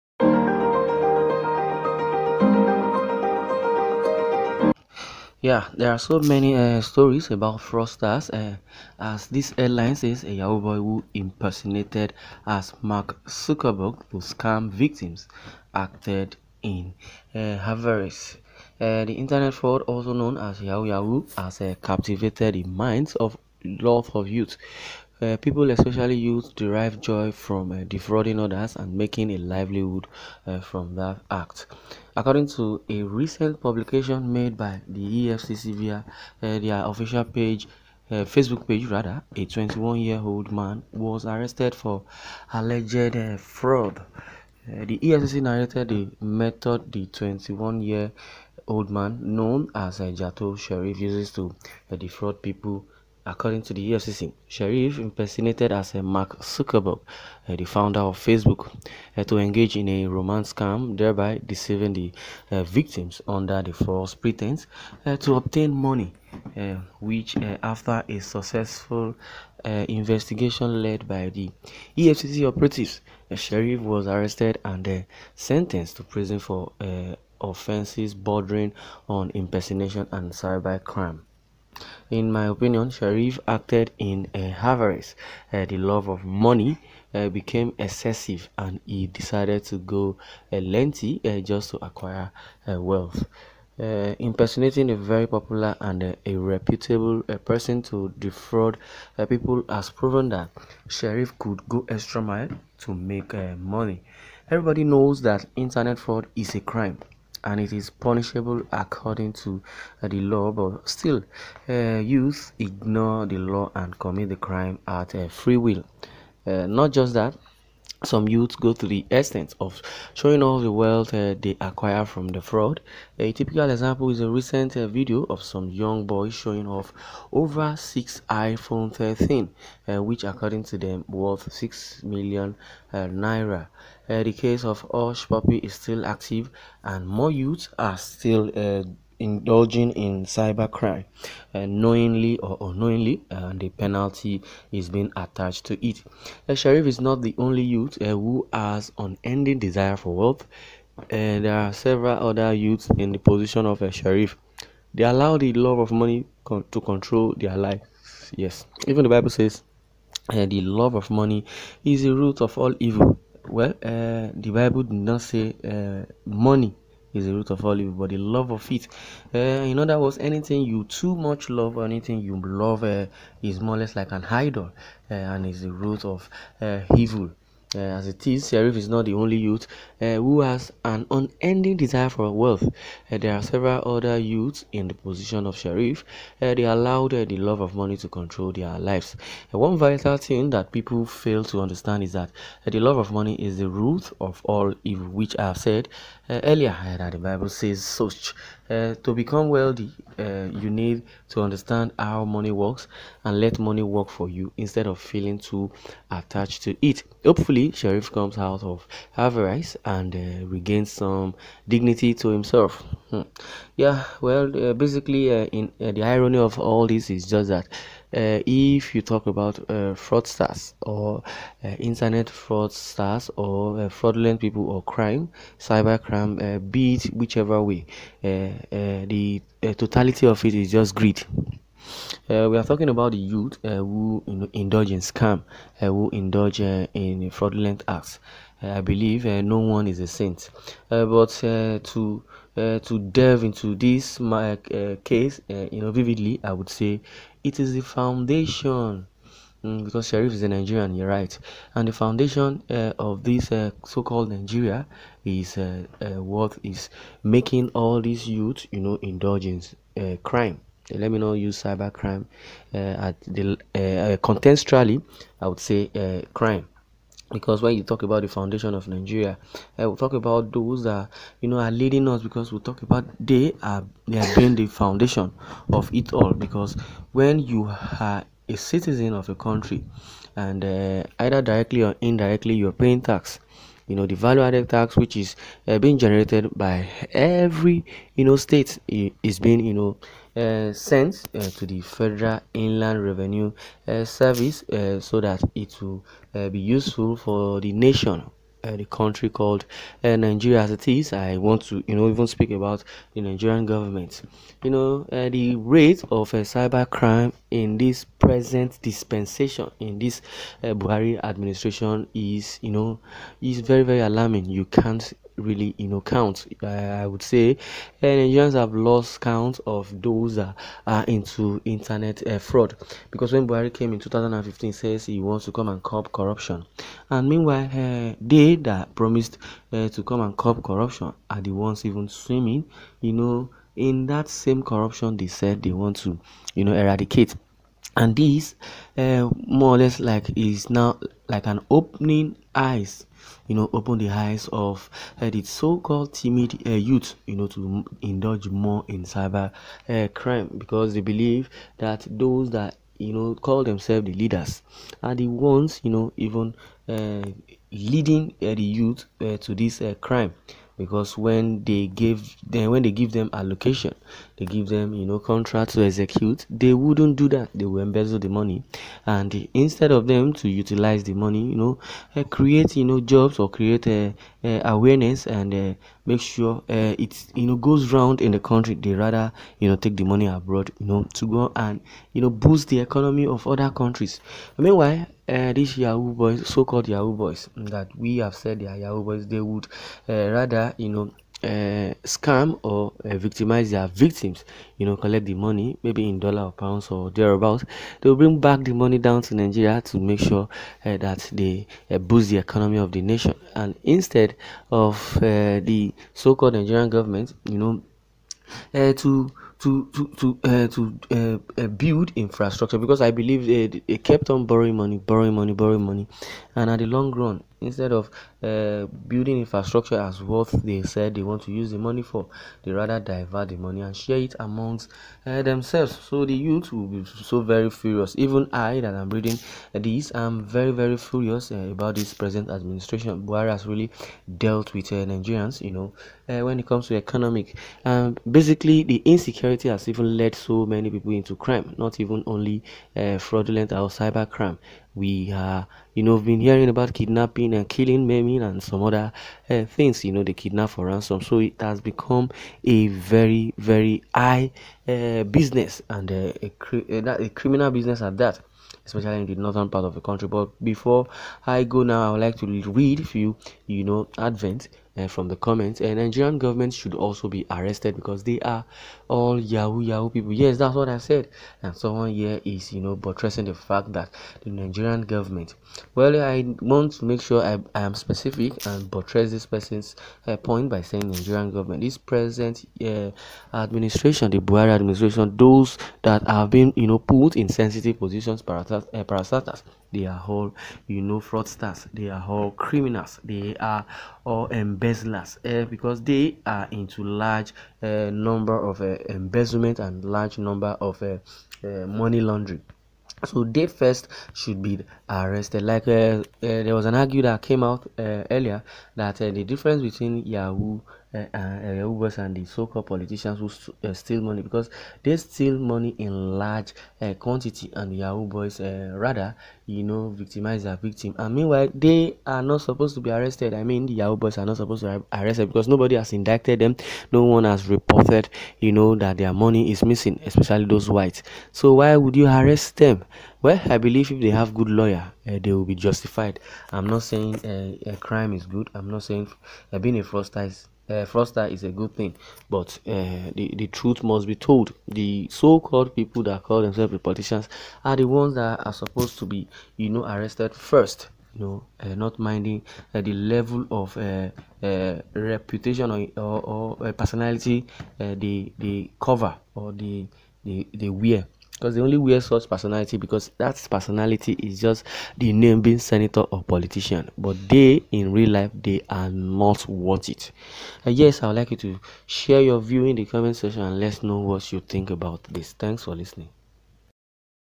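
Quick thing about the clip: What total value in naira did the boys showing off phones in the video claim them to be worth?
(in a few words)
6 million naira.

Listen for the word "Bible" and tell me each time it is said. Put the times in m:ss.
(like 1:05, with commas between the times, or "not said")
2:39, 2:44, 3:17.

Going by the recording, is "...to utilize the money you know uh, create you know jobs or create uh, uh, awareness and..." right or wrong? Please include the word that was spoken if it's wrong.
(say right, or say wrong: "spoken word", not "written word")
right.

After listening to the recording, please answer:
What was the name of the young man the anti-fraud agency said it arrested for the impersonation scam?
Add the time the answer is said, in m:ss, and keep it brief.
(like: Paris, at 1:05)
Jato Sheriff, at 0:50.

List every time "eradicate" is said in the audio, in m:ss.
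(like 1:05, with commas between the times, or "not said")
5:36.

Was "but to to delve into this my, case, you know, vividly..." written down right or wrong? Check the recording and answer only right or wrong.
right.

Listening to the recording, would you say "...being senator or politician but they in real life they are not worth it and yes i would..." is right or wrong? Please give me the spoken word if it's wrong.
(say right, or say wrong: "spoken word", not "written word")
right.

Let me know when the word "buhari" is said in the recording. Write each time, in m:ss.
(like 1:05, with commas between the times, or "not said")
5:10, 5:23, 7:13, 8:04.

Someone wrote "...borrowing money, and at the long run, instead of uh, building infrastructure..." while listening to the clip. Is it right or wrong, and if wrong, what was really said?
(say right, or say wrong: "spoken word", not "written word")
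right.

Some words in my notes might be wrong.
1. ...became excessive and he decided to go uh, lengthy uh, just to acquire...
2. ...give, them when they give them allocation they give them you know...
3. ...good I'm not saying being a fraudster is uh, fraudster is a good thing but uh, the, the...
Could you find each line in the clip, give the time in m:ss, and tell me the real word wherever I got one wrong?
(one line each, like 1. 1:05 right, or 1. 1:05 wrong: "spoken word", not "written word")
1. 1:27 right
2. 6:01 right
3. 8:58 right.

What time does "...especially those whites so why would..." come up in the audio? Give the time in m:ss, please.
8:50.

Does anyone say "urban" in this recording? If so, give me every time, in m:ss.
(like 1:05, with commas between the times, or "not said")
not said.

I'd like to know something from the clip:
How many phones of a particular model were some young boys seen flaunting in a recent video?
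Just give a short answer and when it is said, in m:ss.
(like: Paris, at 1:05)
6, at 2:07.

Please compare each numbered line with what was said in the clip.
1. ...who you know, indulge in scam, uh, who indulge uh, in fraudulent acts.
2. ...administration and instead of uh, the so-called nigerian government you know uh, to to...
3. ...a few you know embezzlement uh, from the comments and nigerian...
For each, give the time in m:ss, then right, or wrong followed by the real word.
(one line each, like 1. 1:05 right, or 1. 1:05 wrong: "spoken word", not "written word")
1. 3:53 right
2. 6:43 wrong: "nation", not "administration"
3. 7:42 wrong: "advent", not "embezzlement".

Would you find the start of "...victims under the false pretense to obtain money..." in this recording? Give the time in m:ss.
1:02.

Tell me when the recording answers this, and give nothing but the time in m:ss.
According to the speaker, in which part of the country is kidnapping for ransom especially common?
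7:39.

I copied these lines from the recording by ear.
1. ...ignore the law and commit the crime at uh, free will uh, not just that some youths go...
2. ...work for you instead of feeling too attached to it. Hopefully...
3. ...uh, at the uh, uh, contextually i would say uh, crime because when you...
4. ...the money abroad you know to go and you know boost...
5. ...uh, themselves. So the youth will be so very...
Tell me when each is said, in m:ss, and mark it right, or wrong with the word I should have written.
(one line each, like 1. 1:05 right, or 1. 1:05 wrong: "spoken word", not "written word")
1. 1:52 right
2. 3:23 right
3. 4:22 right
4. 6:19 right
5. 7:05 right.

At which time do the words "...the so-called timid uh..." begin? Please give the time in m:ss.
5:45.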